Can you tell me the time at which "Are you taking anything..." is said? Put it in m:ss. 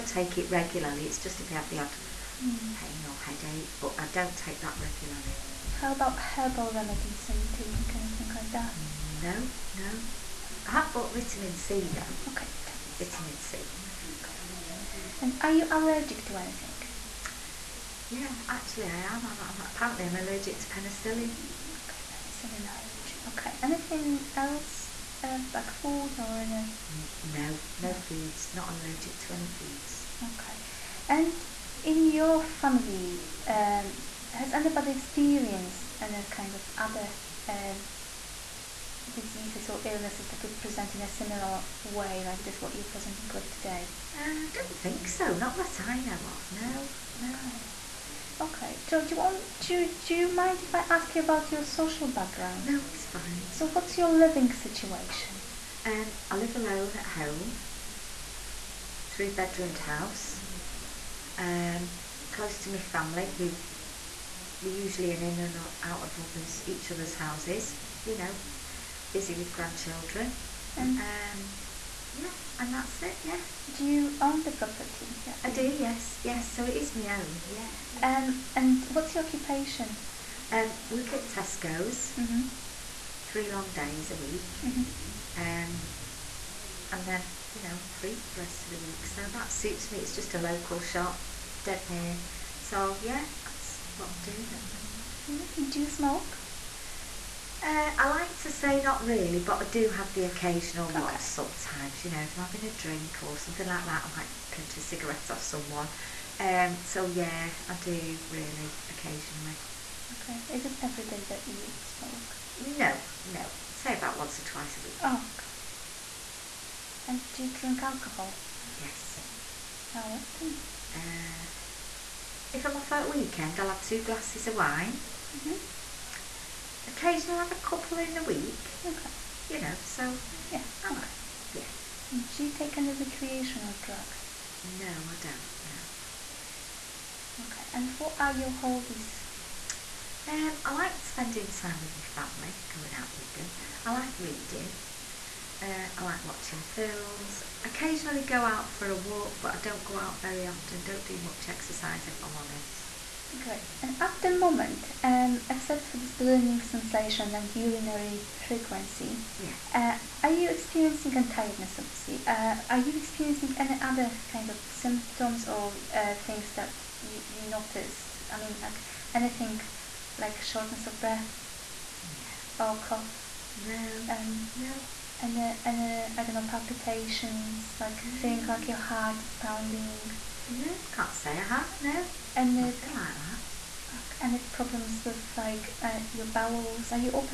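0:07.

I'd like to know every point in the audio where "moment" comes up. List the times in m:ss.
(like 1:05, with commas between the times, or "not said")
1:34, 2:34.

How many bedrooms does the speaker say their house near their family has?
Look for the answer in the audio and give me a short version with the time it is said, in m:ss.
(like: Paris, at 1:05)
3, at 0:59.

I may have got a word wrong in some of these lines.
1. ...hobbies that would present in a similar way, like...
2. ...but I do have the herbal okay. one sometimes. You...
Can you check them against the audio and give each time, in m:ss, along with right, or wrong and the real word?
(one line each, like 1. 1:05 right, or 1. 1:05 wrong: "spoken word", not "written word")
1. 0:39 wrong: "illnesses", not "hobbies"
2. 1:39 wrong: "occasional", not "herbal".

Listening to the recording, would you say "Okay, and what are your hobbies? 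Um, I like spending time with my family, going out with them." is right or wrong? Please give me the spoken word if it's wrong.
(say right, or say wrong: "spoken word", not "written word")
right.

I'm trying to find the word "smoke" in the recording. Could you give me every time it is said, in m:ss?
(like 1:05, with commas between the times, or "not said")
1:35, 1:51.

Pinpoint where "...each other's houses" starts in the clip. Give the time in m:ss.
1:06.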